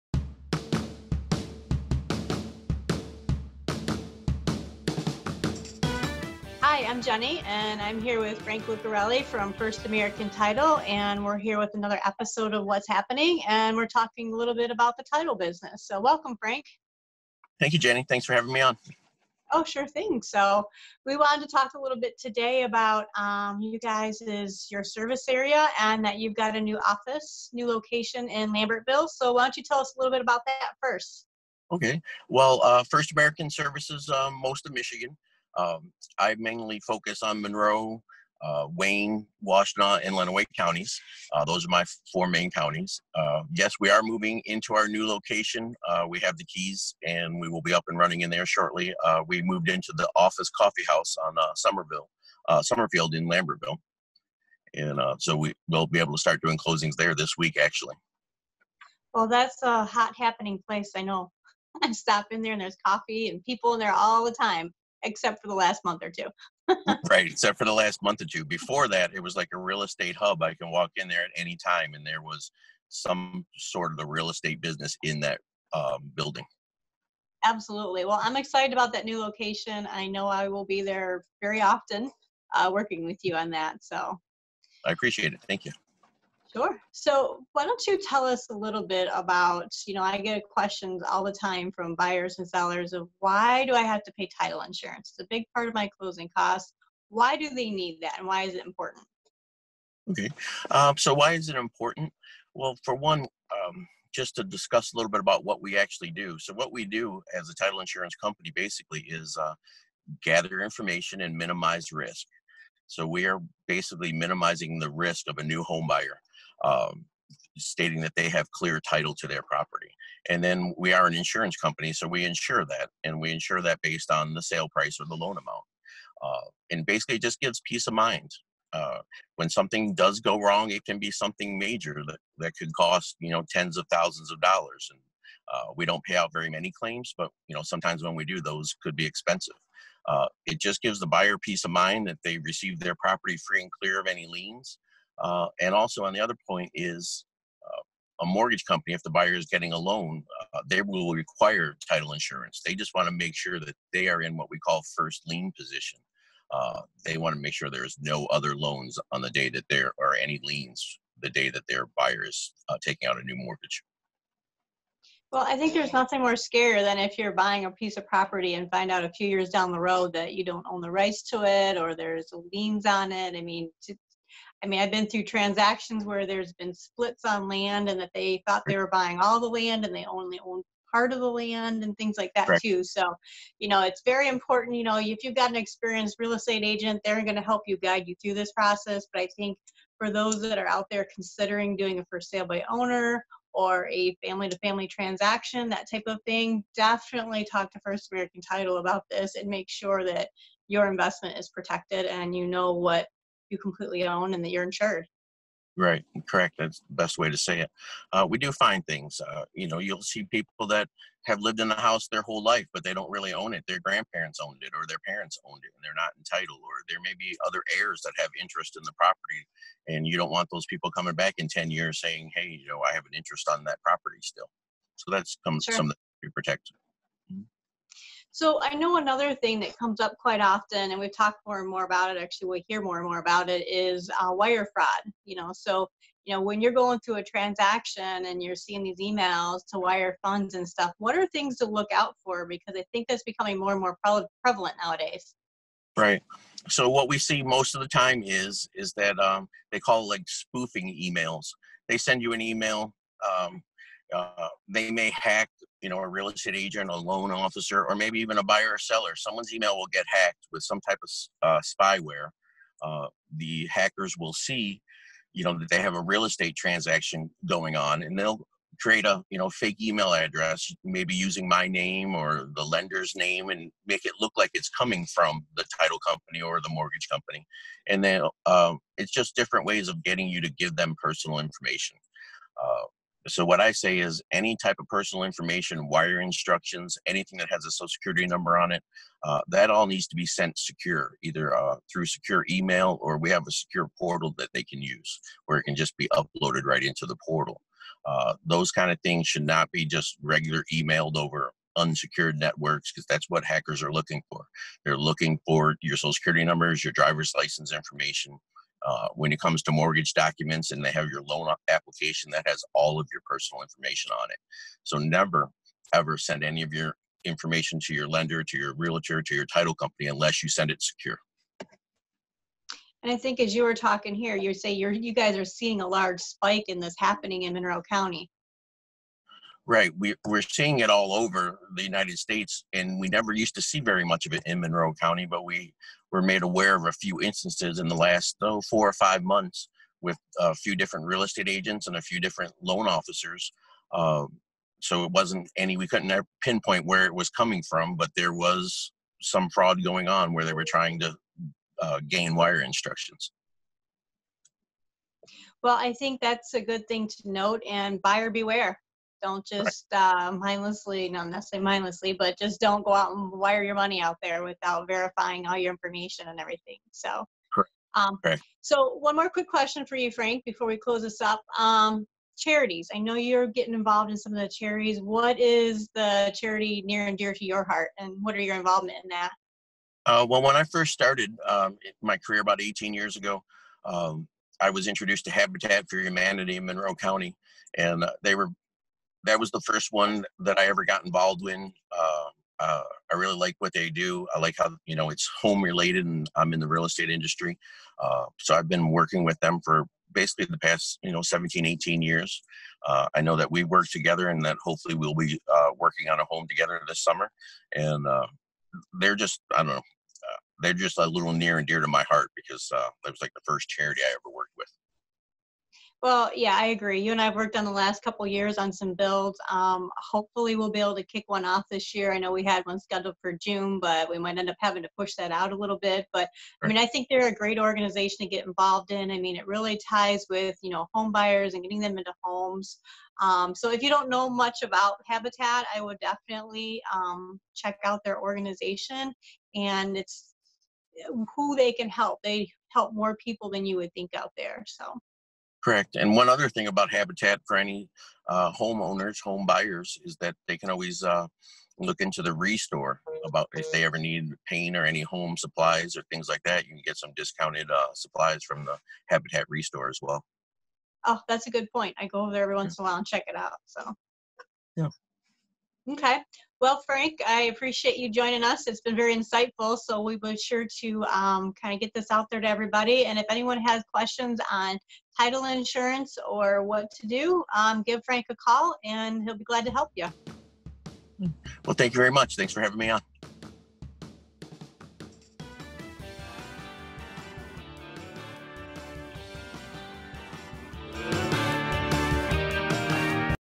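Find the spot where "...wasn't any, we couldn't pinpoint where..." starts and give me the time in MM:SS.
05:45.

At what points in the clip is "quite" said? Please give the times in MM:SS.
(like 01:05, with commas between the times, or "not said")
03:50.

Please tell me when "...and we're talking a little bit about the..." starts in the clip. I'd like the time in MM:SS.
00:13.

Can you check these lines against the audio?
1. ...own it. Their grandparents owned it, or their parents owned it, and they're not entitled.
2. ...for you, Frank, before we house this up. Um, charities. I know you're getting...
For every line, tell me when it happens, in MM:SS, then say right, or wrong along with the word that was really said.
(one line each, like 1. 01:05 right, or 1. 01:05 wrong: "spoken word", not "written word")
1. 03:33 right
2. 06:09 wrong: "close", not "house".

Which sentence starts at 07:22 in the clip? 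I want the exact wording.
They help more people than you would think out there.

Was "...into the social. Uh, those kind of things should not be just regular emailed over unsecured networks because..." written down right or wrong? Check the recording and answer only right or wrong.
wrong.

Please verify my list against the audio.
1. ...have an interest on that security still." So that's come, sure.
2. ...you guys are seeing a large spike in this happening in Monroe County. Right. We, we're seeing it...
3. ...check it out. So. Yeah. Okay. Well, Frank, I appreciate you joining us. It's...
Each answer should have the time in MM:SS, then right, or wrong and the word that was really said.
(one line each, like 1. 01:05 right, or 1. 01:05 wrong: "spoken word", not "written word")
1. 03:42 wrong: "property", not "security"
2. 05:24 right
3. 07:43 right.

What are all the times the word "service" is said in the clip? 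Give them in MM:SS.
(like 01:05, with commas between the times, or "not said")
00:24, 00:33.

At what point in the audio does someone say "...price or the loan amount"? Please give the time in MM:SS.
02:04.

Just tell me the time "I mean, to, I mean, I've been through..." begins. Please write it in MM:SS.
02:53.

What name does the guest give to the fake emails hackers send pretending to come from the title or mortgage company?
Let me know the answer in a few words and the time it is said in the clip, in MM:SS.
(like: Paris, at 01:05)
spoofing emails, at 04:10.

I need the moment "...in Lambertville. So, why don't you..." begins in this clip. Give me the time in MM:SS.
00:28.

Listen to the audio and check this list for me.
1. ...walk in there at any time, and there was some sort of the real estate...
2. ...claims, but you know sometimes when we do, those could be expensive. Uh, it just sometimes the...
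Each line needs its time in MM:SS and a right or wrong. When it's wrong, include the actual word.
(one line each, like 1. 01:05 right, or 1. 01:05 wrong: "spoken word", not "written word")
1. 01:10 right
2. 02:16 wrong: "gives", not "sometimes".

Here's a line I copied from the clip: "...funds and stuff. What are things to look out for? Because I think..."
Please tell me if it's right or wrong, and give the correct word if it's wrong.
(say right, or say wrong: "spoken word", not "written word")
right.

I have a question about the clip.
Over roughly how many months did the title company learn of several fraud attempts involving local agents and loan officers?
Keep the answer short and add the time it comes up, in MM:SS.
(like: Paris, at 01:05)
4 or 5 months, at 05:38.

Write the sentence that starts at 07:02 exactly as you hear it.
I know we had one scheduled for June, but we might end up having to push that out a little bit.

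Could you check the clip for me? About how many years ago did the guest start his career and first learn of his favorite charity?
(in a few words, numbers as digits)
18 years.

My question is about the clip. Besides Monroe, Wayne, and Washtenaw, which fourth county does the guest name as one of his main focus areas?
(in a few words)
Lenawee.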